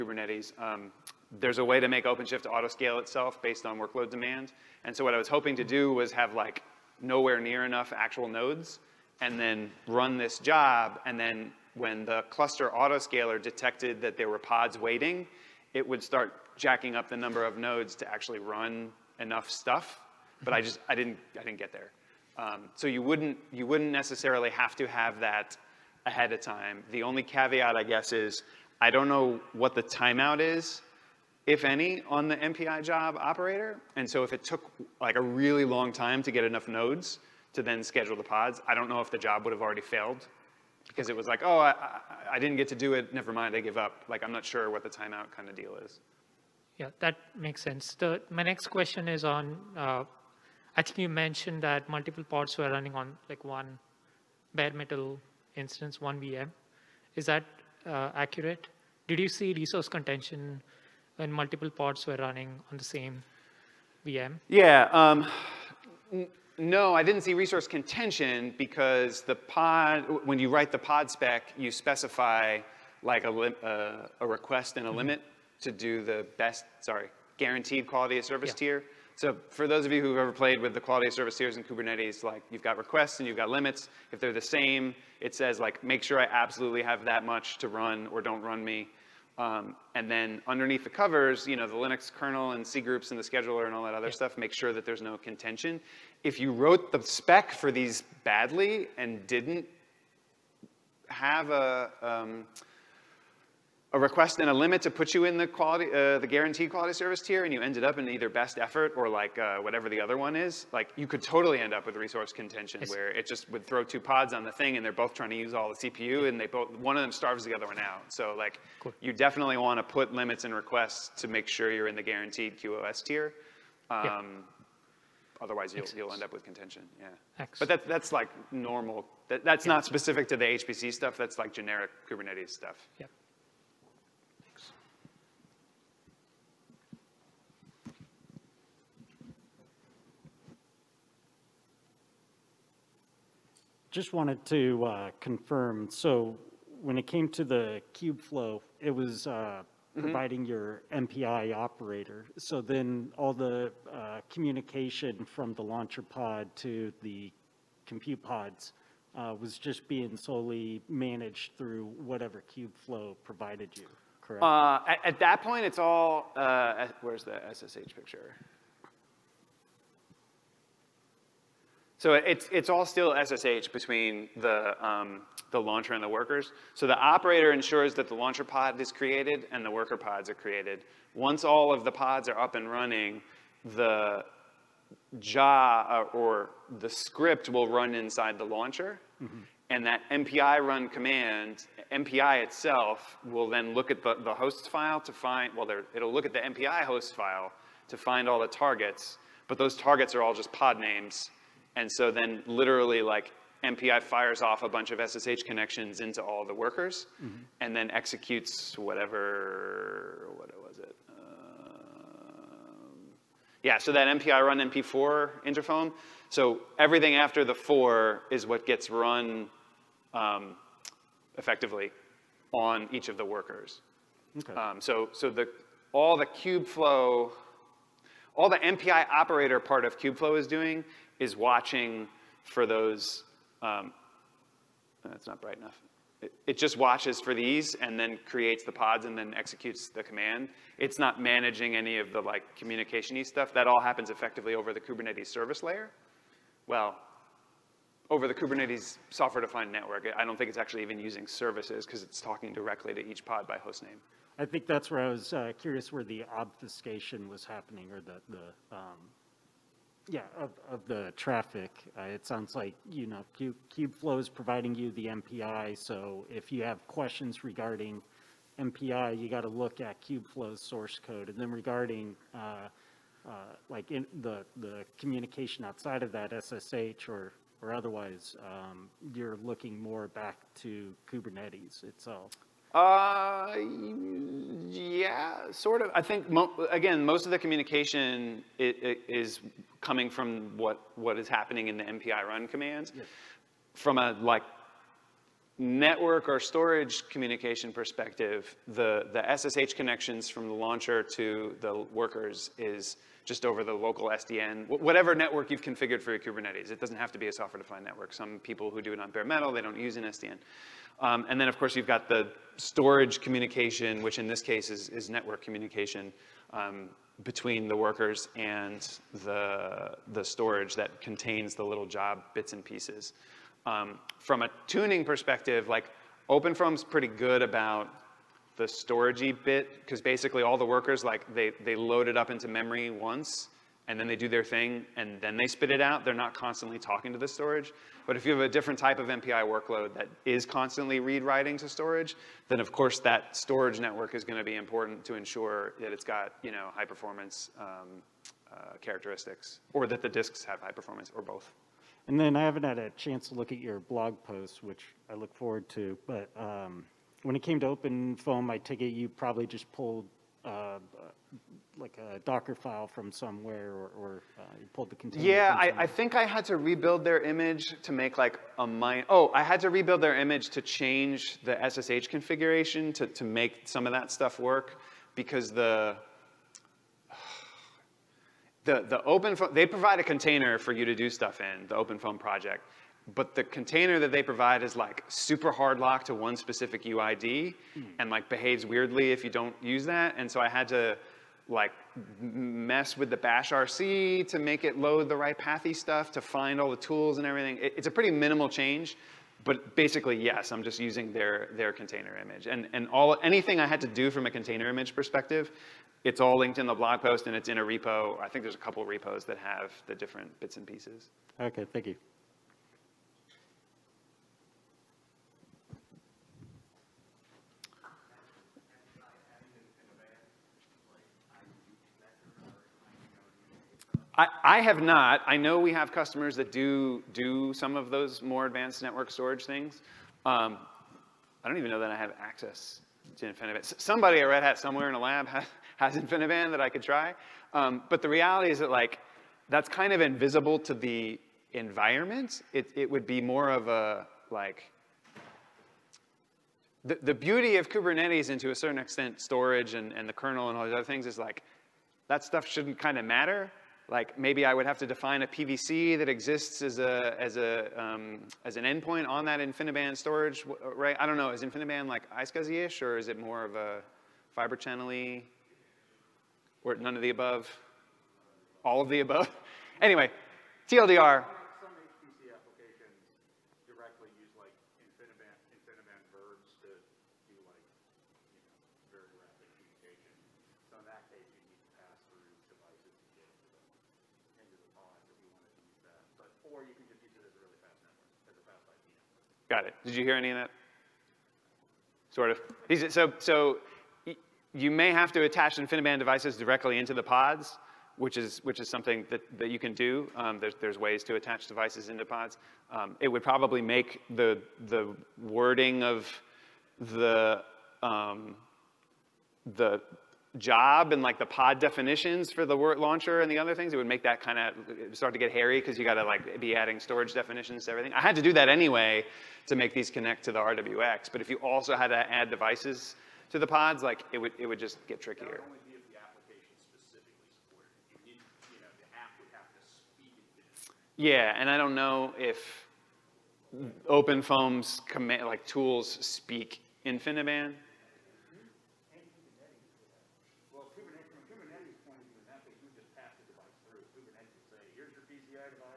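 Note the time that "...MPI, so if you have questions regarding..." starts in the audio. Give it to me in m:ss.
4:25.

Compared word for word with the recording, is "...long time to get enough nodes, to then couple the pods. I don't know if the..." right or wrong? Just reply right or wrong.
wrong.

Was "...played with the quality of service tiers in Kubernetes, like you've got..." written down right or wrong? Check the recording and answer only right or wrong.
right.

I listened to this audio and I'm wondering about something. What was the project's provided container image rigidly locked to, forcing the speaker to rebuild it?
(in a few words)
one specific UID.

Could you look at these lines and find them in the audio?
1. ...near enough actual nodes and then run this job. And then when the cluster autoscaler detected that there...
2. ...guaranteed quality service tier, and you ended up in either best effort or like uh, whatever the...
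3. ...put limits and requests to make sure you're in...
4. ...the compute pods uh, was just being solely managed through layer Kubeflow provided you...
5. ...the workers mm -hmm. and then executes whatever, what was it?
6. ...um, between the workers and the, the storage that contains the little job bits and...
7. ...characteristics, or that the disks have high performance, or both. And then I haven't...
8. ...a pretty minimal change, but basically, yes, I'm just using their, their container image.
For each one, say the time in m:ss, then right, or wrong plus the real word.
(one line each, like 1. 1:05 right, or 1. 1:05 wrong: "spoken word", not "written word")
1. 0:07 right
2. 1:46 right
3. 1:59 right
4. 2:37 wrong: "whatever", not "layer"
5. 3:26 right
6. 5:16 right
7. 5:48 right
8. 6:37 right.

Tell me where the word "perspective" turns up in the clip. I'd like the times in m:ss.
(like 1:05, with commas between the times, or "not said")
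4:57, 5:25, 6:44.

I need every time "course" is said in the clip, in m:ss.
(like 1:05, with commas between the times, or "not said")
5:11, 5:42.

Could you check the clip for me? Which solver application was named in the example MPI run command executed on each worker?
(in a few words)
interFoam.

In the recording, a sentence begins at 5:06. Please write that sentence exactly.
It doesn't have to be a software-defined network.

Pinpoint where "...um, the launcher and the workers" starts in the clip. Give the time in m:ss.
2:54.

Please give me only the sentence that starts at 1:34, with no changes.
stuff make sure that there's no contention.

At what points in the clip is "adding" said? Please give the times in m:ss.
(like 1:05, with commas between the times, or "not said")
8:36.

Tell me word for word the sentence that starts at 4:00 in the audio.
It's not managing any of the like communication-y stuff.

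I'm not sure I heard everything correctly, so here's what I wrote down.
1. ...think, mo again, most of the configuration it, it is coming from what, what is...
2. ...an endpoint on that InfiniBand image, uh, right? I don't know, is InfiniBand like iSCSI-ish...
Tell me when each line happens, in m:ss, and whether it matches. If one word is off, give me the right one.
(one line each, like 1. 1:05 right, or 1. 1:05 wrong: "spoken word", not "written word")
1. 4:46 wrong: "communication", not "configuration"
2. 7:38 wrong: "storage", not "image".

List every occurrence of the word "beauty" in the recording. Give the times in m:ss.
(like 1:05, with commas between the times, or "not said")
7:27.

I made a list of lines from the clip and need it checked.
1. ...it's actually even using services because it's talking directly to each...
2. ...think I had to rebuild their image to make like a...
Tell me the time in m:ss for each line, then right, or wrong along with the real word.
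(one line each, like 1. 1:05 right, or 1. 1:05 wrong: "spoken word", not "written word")
1. 4:10 right
2. 6:05 right.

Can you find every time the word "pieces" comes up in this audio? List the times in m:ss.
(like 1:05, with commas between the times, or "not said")
5:22, 6:50.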